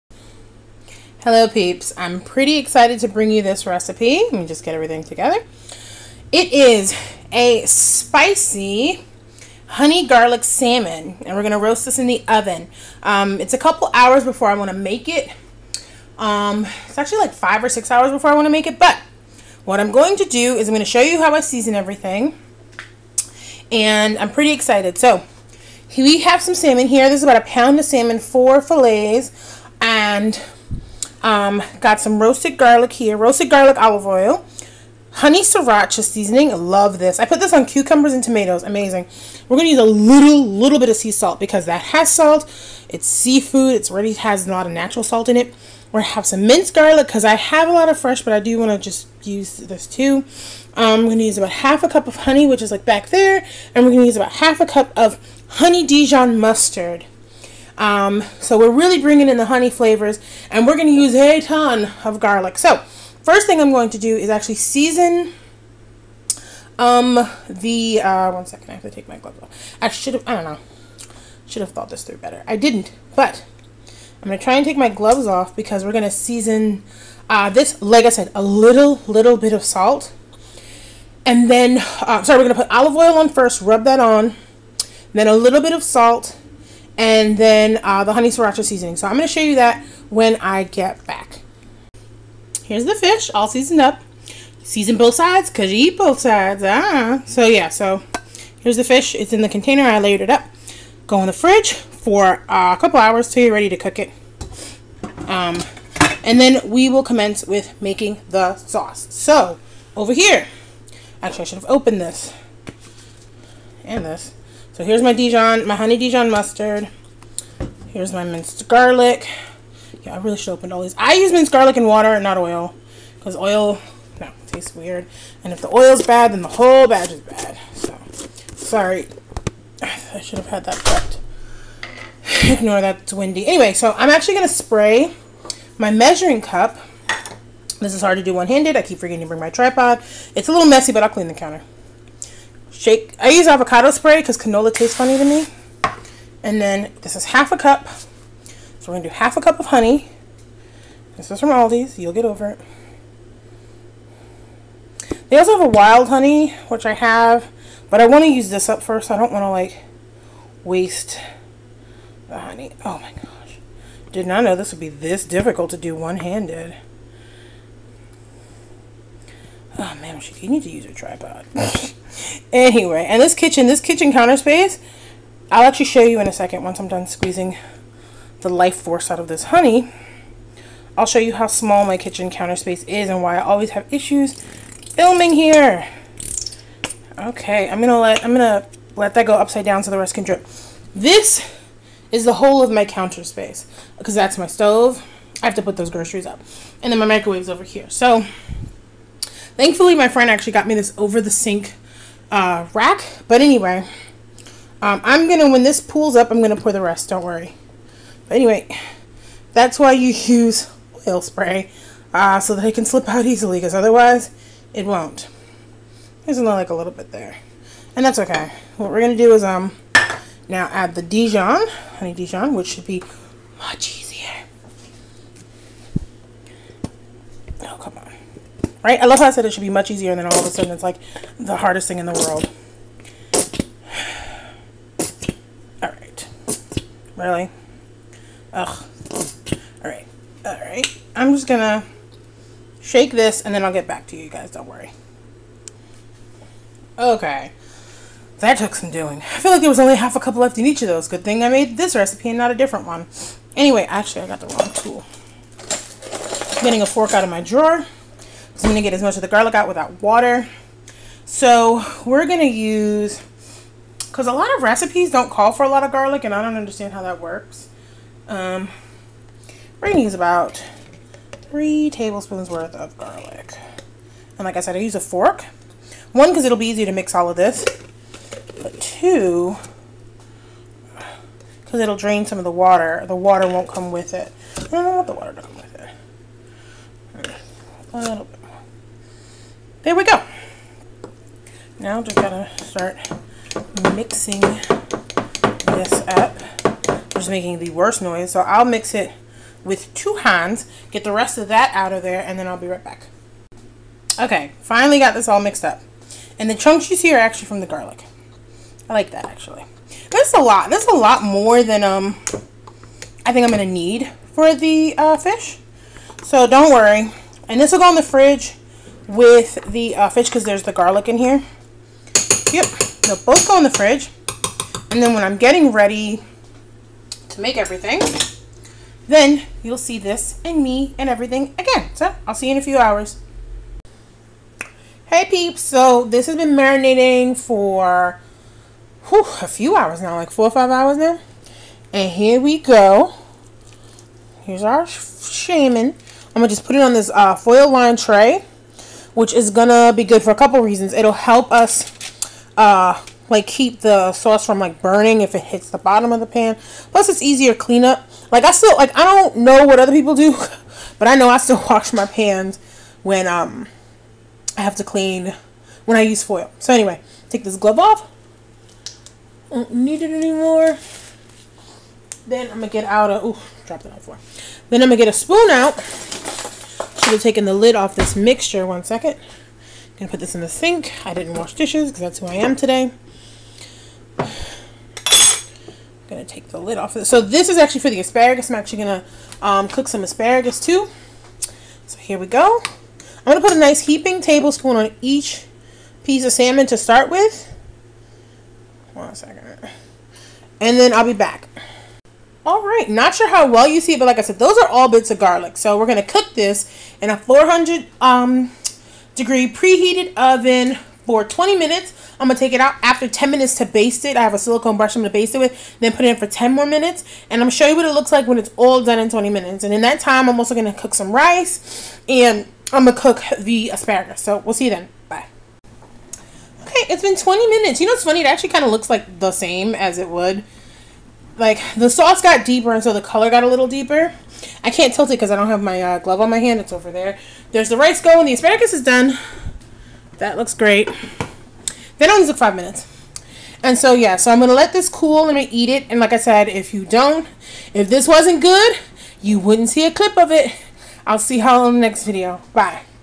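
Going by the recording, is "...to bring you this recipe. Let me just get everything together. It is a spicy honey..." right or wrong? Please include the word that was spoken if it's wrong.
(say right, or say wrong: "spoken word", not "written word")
right.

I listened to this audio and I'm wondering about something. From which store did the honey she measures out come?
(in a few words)
Aldi's.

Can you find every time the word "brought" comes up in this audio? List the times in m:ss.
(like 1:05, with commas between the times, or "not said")
not said.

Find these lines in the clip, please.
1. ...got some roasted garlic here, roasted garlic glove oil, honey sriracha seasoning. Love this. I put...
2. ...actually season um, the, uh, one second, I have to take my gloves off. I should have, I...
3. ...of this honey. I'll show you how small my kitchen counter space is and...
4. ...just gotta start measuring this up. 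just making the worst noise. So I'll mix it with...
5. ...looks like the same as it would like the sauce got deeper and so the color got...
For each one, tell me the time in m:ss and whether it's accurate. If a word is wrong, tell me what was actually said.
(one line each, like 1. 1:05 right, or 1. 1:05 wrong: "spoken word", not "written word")
1. 0:31 wrong: "olive", not "glove"
2. 1:04 right
3. 2:59 right
4. 4:52 wrong: "mixing", not "measuring"
5. 7:08 right.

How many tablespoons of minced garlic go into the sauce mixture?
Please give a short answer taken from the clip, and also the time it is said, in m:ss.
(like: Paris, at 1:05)
3, at 4:31.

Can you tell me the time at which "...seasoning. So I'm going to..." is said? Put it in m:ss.
1:28.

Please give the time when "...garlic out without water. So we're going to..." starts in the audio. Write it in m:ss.
4:19.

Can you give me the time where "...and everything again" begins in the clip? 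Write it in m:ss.
5:30.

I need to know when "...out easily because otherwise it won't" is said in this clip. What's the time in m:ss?
3:33.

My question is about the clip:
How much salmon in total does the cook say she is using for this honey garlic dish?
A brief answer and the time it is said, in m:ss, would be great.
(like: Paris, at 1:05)
About a pound, at 0:27.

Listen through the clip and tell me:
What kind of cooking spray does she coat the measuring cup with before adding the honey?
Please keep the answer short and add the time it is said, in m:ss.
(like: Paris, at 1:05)
Avocado spray, at 2:23.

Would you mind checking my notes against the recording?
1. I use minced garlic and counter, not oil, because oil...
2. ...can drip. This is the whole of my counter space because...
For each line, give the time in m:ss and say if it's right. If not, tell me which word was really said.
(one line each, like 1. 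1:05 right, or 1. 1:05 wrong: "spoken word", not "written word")
1. 2:00 wrong: "water", not "counter"
2. 3:10 right.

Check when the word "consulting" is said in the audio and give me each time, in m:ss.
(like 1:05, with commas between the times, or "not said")
not said.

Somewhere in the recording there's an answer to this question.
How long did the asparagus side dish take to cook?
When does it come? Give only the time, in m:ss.
7:22.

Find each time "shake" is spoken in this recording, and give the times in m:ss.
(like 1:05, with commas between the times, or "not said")
2:22, 4:02.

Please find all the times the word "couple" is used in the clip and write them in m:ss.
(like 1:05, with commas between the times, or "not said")
0:13, 1:42, 5:50.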